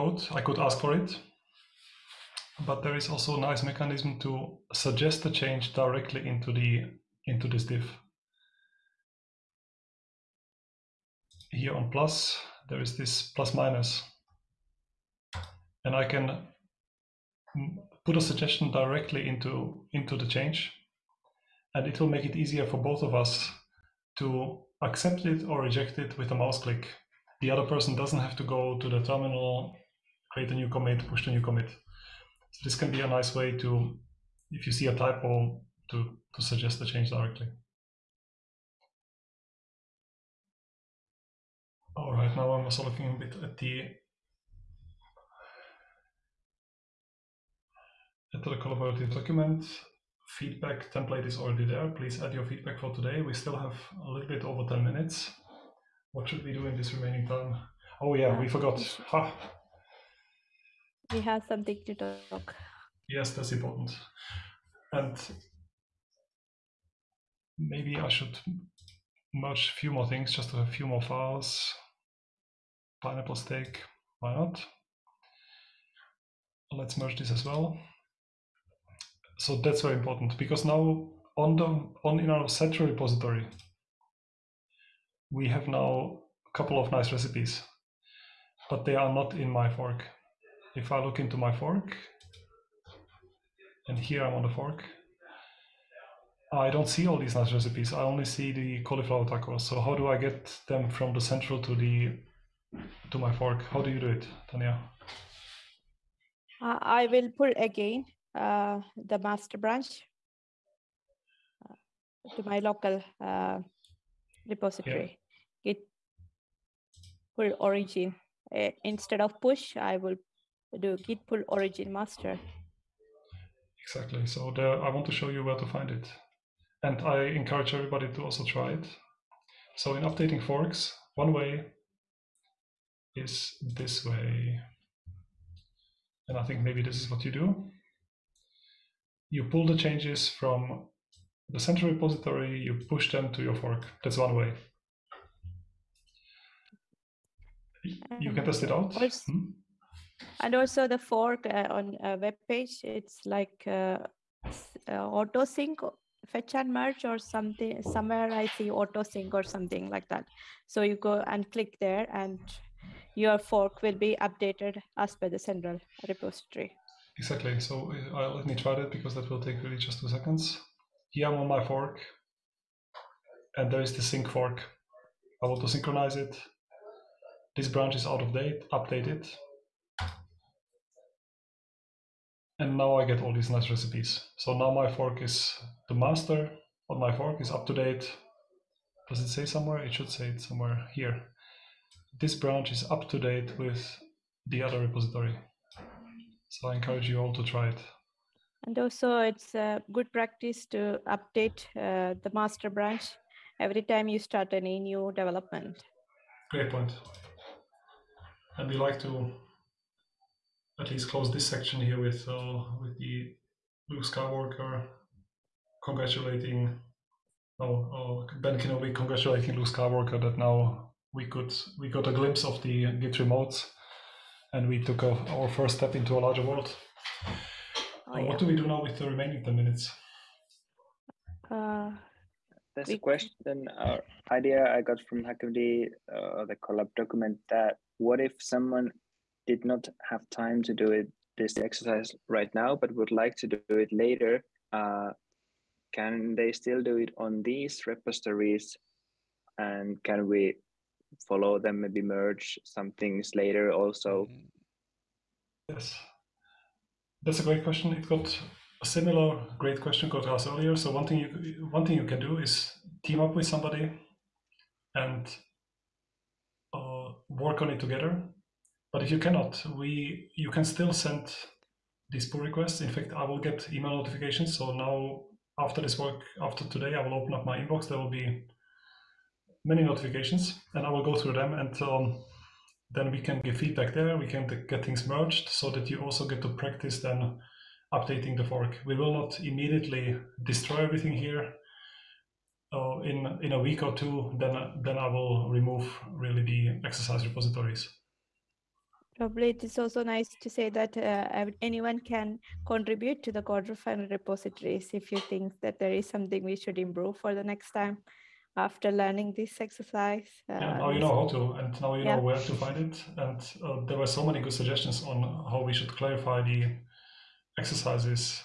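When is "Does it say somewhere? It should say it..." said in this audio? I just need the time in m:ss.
3:09.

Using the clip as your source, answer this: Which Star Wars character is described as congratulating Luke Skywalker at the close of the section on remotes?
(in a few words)
Ben Kenobi.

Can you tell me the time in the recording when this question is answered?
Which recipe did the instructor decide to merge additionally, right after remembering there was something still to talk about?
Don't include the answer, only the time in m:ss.
1:13.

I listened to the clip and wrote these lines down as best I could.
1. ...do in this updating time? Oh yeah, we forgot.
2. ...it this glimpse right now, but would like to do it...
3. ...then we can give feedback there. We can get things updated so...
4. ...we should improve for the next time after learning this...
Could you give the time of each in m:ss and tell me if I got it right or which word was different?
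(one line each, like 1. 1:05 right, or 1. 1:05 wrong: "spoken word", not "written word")
1. 0:56 wrong: "remaining", not "updating"
2. 4:00 wrong: "exercise", not "glimpse"
3. 4:42 wrong: "merged", not "updated"
4. 5:06 right.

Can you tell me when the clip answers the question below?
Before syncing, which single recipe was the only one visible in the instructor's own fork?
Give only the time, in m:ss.
1:38.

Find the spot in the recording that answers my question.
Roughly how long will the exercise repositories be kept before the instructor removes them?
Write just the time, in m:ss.
4:53.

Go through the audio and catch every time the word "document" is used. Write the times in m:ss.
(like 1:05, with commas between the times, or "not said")
0:49, 3:56.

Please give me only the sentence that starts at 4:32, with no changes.
In fact, I will get email notifications.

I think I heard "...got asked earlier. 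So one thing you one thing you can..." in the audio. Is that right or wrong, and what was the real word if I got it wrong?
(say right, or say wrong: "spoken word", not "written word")
right.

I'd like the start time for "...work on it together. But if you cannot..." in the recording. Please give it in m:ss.
4:27.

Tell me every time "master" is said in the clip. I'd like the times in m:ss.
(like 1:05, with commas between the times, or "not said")
1:49, 2:01, 3:05, 3:22.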